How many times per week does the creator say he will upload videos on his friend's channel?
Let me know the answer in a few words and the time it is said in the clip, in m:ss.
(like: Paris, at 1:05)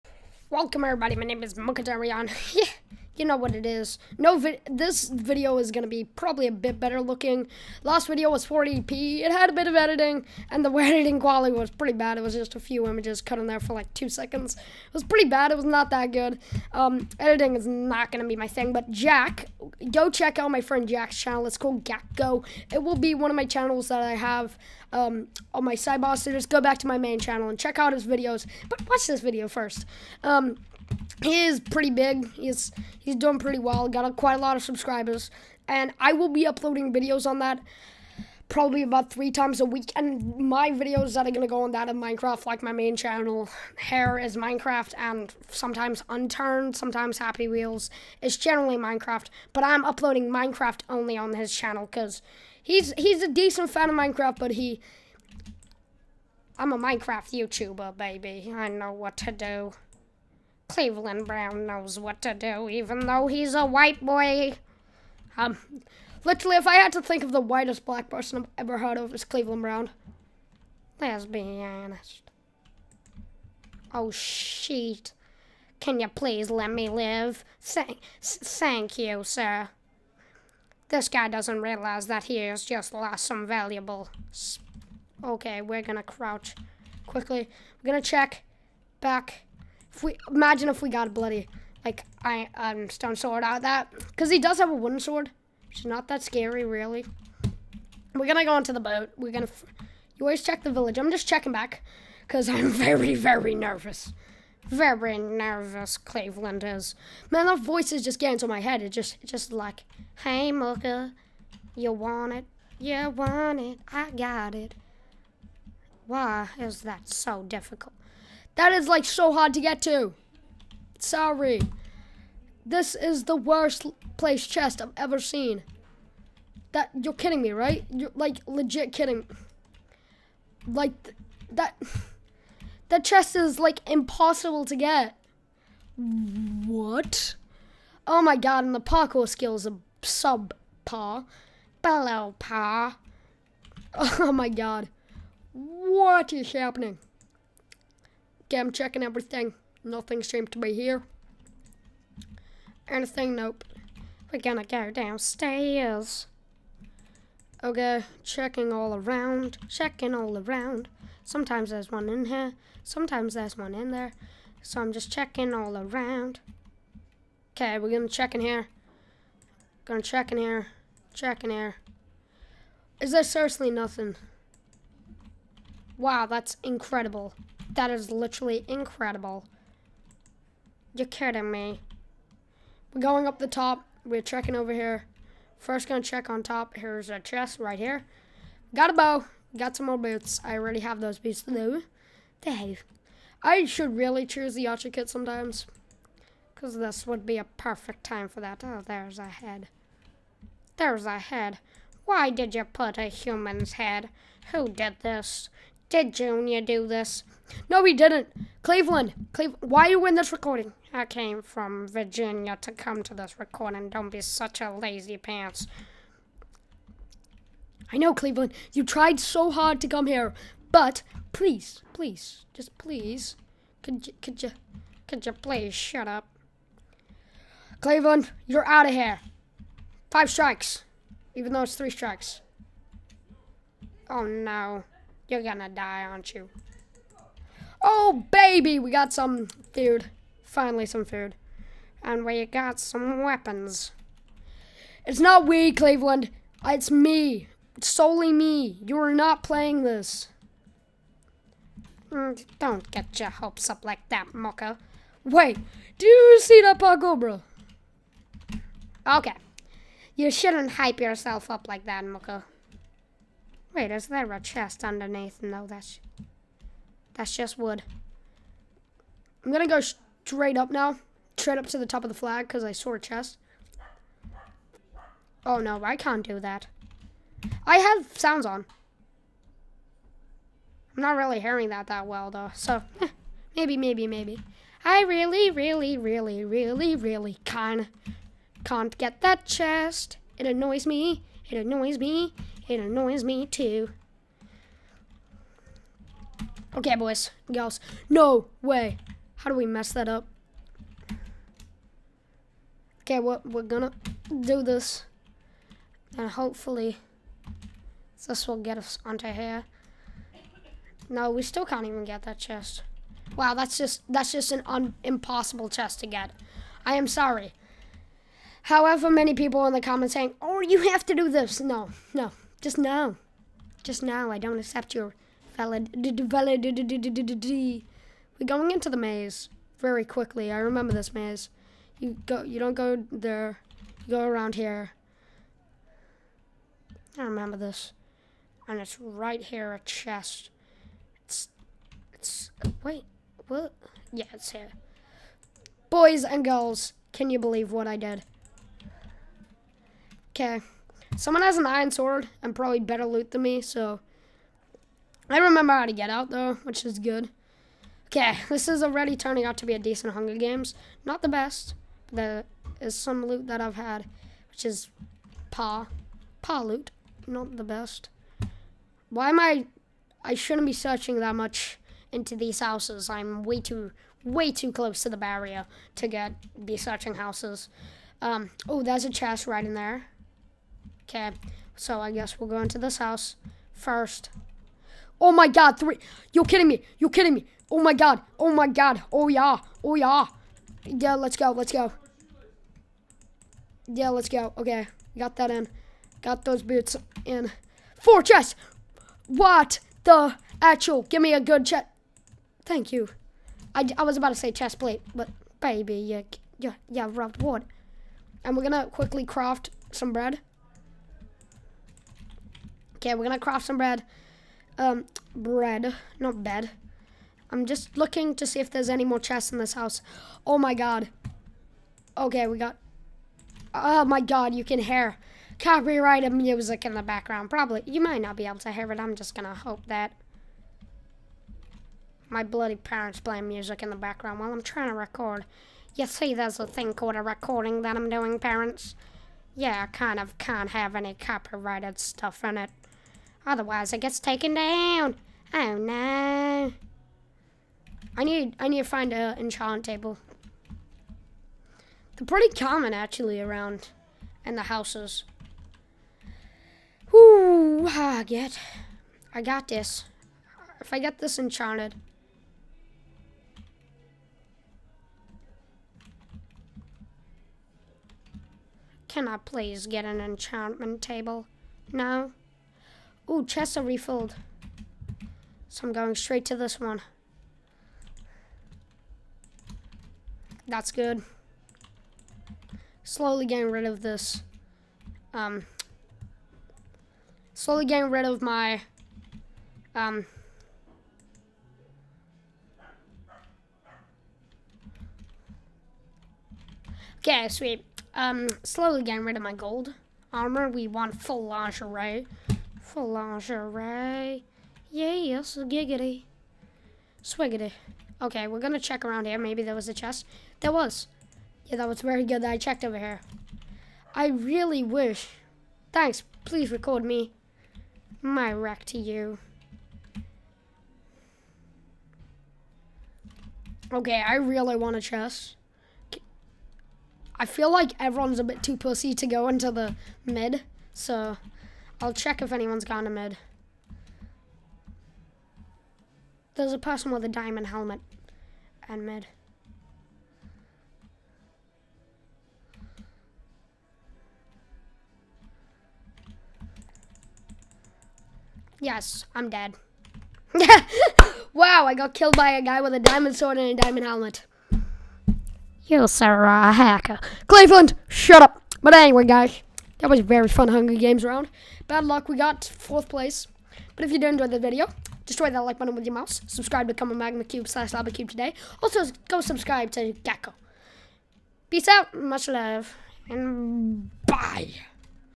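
3, at 0:39.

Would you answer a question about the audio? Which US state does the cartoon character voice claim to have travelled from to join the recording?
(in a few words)
Virginia.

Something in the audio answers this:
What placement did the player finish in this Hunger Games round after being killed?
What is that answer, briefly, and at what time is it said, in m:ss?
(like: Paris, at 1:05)
fourth place, at 9:22.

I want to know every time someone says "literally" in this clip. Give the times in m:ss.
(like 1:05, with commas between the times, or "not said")
1:06, 2:58.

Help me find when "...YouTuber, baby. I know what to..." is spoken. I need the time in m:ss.
0:57.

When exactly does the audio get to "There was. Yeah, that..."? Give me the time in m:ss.
8:30.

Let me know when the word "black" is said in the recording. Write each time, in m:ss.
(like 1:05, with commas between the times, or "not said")
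1:07.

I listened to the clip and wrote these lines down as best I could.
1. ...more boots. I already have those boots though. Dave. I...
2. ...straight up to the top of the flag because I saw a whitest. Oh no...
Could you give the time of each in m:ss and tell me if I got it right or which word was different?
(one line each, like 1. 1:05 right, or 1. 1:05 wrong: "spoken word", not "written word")
1. 3:09 right
2. 4:31 wrong: "chest", not "whitest".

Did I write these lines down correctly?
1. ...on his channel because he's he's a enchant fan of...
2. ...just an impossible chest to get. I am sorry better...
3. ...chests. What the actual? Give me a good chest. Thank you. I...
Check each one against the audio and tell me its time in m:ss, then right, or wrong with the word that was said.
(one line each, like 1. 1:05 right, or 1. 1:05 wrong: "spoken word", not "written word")
1. 0:51 wrong: "decent", not "enchant"
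2. 5:14 wrong: "however", not "better"
3. 6:38 right.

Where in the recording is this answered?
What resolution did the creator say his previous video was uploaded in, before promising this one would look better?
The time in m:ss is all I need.
0:08.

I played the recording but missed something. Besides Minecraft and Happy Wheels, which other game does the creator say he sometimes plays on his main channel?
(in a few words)
Unturned.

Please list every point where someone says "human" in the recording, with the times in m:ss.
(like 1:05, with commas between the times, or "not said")
3:23.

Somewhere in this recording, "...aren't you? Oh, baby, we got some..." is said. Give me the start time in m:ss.
3:56.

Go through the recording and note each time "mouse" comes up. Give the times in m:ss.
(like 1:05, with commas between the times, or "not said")
9:26.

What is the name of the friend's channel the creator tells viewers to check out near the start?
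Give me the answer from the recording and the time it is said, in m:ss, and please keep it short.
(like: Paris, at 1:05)
Gakko, at 0:21.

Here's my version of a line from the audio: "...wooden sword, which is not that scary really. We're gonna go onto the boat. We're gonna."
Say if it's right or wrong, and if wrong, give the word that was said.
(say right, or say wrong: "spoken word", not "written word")
right.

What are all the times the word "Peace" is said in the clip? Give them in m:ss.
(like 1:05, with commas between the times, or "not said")
9:31.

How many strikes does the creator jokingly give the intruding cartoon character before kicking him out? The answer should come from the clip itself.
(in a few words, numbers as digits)
5.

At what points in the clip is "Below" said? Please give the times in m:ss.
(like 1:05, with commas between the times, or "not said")
2:21.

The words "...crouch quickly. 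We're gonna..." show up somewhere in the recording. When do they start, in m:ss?
1:26.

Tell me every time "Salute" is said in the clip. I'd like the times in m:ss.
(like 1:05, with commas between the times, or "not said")
not said.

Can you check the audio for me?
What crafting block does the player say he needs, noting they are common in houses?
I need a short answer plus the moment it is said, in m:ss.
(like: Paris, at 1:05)
enchant table, at 7:29.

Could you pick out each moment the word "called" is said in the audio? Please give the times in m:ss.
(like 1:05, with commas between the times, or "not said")
0:21, 7:16.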